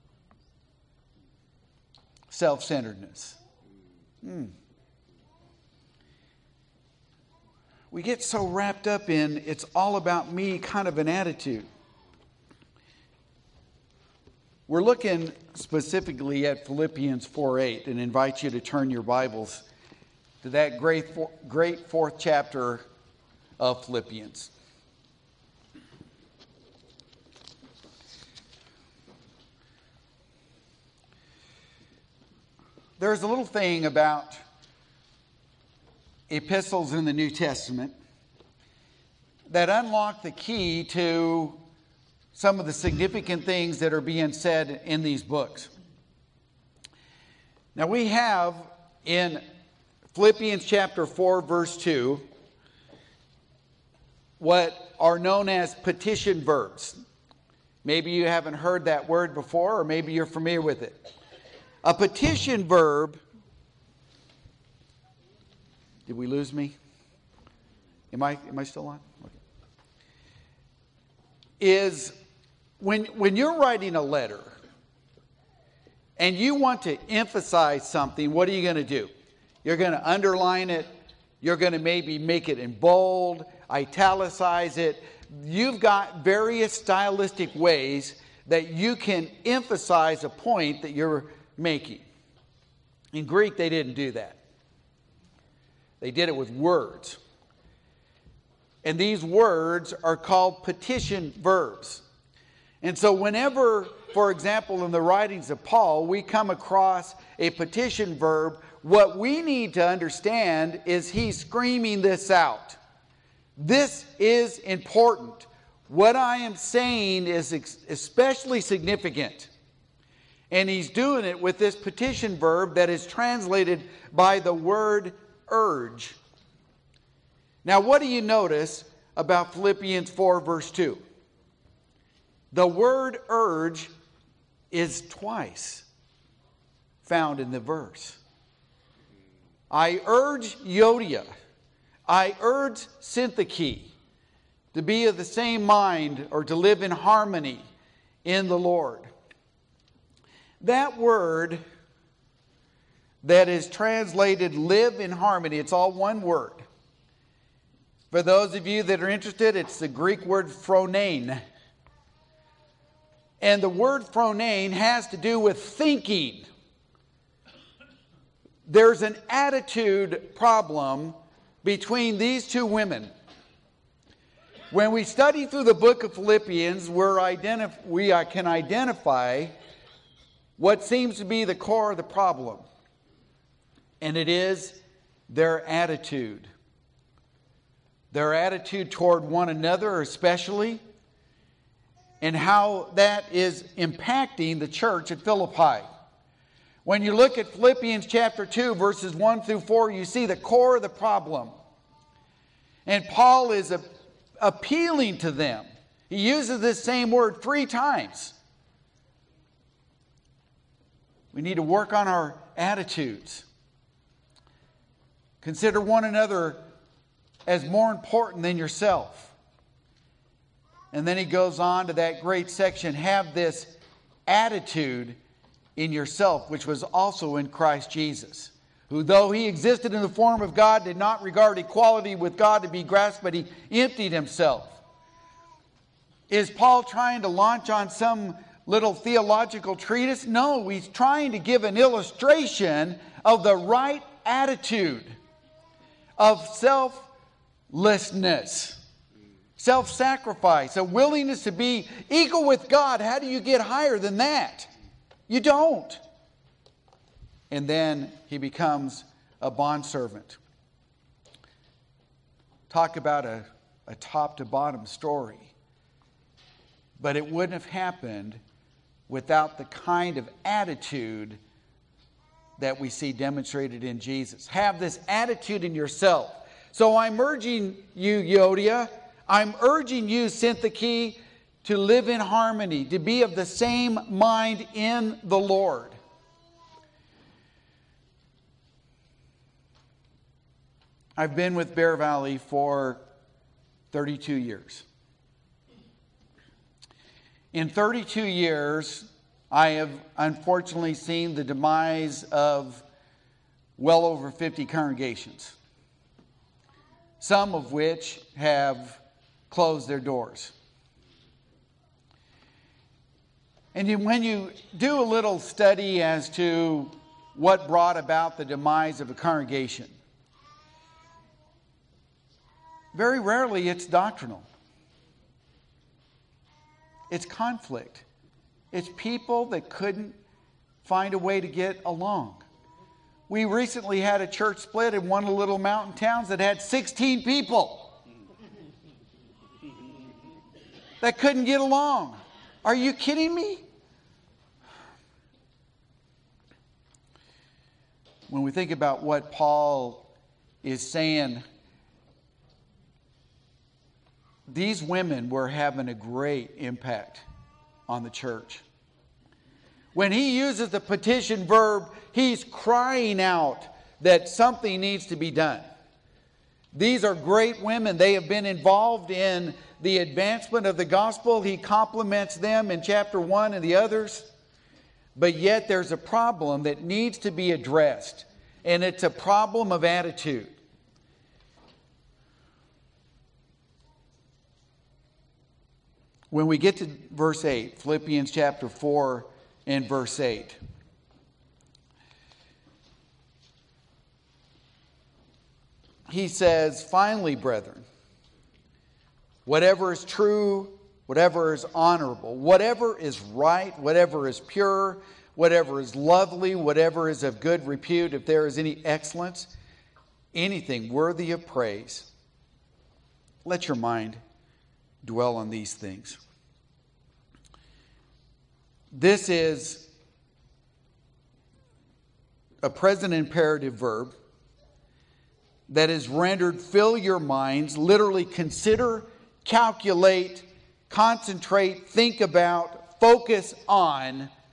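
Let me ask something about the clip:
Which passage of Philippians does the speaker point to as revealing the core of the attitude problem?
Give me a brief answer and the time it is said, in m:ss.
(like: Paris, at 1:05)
Philippians 2:1-4, at 3:17.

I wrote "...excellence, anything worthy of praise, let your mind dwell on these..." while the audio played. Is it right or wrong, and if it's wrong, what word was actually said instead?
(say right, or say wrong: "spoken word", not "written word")
right.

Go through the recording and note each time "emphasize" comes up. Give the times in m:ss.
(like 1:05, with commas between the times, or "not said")
1:17, 1:29.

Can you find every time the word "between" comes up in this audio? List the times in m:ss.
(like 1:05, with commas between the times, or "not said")
2:51.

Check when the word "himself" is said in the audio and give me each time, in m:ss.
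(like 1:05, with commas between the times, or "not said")
3:54.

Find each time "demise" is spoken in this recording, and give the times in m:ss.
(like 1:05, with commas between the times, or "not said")
5:01, 5:18.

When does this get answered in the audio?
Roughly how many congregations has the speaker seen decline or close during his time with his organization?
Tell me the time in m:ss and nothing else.
5:03.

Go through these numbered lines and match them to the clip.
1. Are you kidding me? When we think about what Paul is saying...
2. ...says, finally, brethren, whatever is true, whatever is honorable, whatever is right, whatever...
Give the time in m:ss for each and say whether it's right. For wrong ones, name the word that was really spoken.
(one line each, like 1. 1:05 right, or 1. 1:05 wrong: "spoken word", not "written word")
1. 5:42 right
2. 6:36 right.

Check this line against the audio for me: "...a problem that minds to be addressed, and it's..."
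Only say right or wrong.
wrong.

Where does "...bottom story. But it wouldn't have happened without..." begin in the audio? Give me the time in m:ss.
4:24.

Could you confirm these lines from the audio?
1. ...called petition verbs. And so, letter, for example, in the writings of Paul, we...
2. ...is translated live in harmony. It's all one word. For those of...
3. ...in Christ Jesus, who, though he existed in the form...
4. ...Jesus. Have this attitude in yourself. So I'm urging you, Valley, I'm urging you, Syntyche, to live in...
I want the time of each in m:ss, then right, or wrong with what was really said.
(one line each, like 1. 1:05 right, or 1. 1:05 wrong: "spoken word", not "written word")
1. 1:40 wrong: "whenever", not "letter"
2. 2:33 right
3. 3:47 right
4. 4:33 wrong: "Euodia", not "Valley".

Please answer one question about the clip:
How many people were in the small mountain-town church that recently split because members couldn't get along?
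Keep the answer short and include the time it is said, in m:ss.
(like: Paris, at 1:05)
16, at 5:36.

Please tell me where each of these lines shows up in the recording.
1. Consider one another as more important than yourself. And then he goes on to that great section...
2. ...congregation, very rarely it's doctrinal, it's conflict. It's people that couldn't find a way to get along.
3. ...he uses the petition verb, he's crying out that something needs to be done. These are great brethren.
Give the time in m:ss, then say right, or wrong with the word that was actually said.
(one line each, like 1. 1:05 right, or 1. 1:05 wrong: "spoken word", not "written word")
1. 3:35 right
2. 5:19 right
3. 6:00 wrong: "women", not "brethren".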